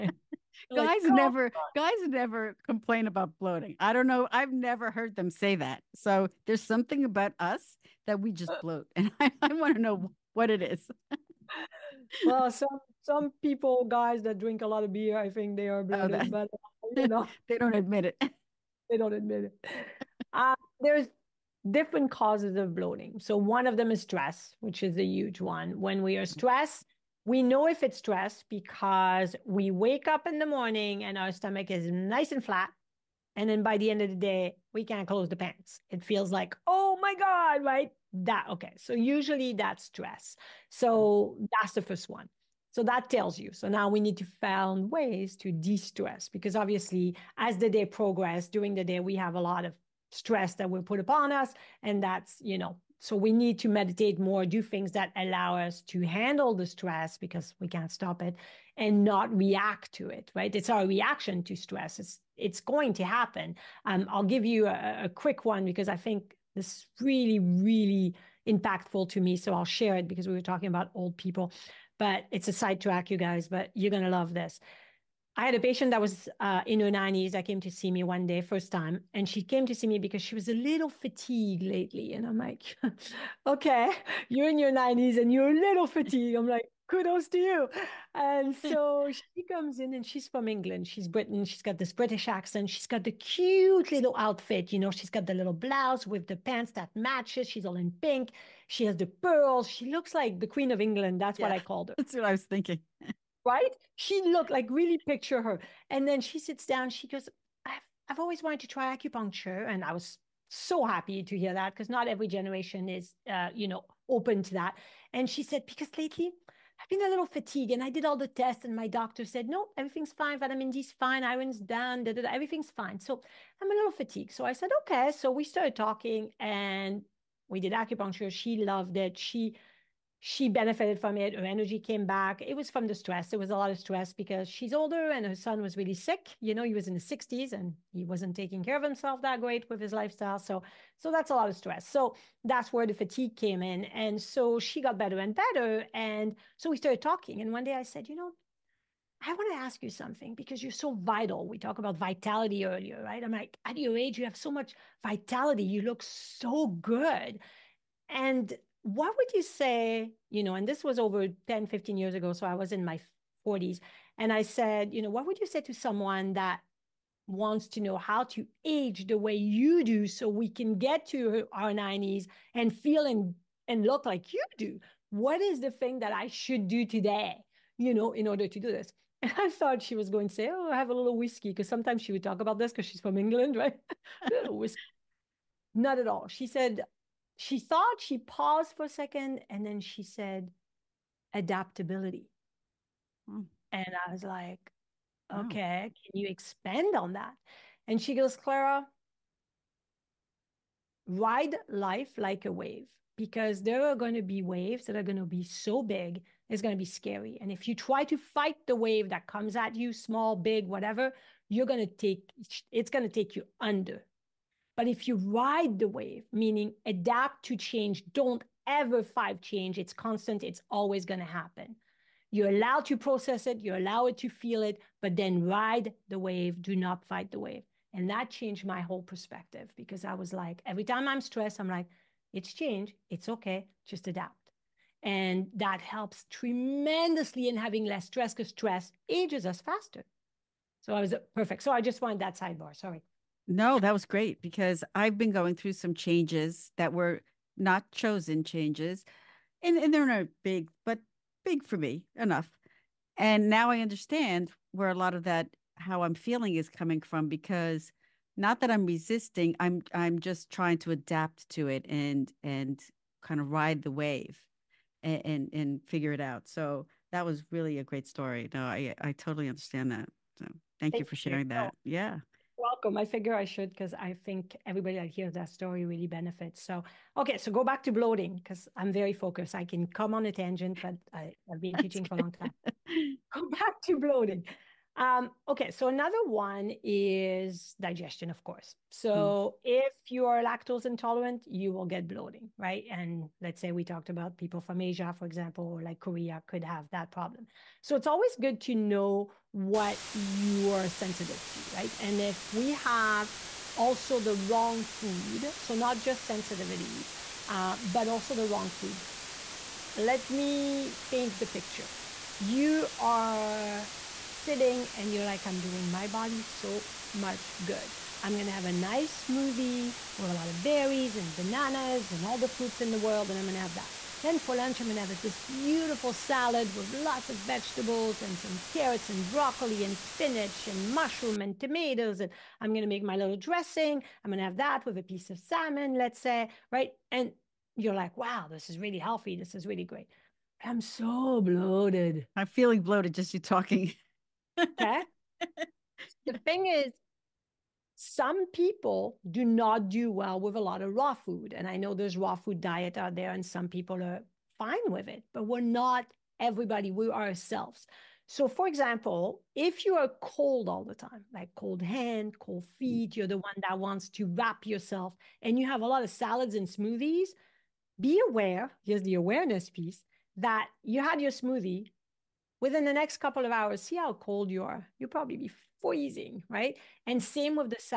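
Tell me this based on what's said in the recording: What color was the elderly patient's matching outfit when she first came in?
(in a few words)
Pink.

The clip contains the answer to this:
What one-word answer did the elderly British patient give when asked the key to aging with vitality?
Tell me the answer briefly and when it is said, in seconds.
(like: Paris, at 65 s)
Adaptability, at 191 s.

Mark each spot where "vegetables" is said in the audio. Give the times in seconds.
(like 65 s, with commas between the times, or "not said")
327 s.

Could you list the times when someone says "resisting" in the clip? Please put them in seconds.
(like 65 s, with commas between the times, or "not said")
258 s.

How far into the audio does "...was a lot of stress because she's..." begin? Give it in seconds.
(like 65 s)
133 s.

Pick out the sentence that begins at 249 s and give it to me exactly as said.
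And, and they're not big, but big for me enough.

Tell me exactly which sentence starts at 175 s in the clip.
What is the thing that I should do today, you know, in order to do this?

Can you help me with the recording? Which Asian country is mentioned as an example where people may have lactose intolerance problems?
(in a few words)
Korea.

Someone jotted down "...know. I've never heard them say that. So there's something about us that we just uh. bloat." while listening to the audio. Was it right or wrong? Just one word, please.
right.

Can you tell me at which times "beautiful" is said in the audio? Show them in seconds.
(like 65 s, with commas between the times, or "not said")
325 s.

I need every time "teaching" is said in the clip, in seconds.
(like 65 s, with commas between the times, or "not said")
281 s.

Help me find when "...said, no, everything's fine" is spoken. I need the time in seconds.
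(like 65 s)
119 s.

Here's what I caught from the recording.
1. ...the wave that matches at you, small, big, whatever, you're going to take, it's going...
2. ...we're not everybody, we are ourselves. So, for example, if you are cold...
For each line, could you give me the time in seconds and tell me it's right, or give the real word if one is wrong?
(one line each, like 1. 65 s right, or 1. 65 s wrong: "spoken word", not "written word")
1. 208 s wrong: "comes", not "matches"
2. 355 s right.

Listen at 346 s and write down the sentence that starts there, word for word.
the thing is, some people do not do well with a lot of raw food.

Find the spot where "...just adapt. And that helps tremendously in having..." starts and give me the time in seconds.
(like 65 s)
233 s.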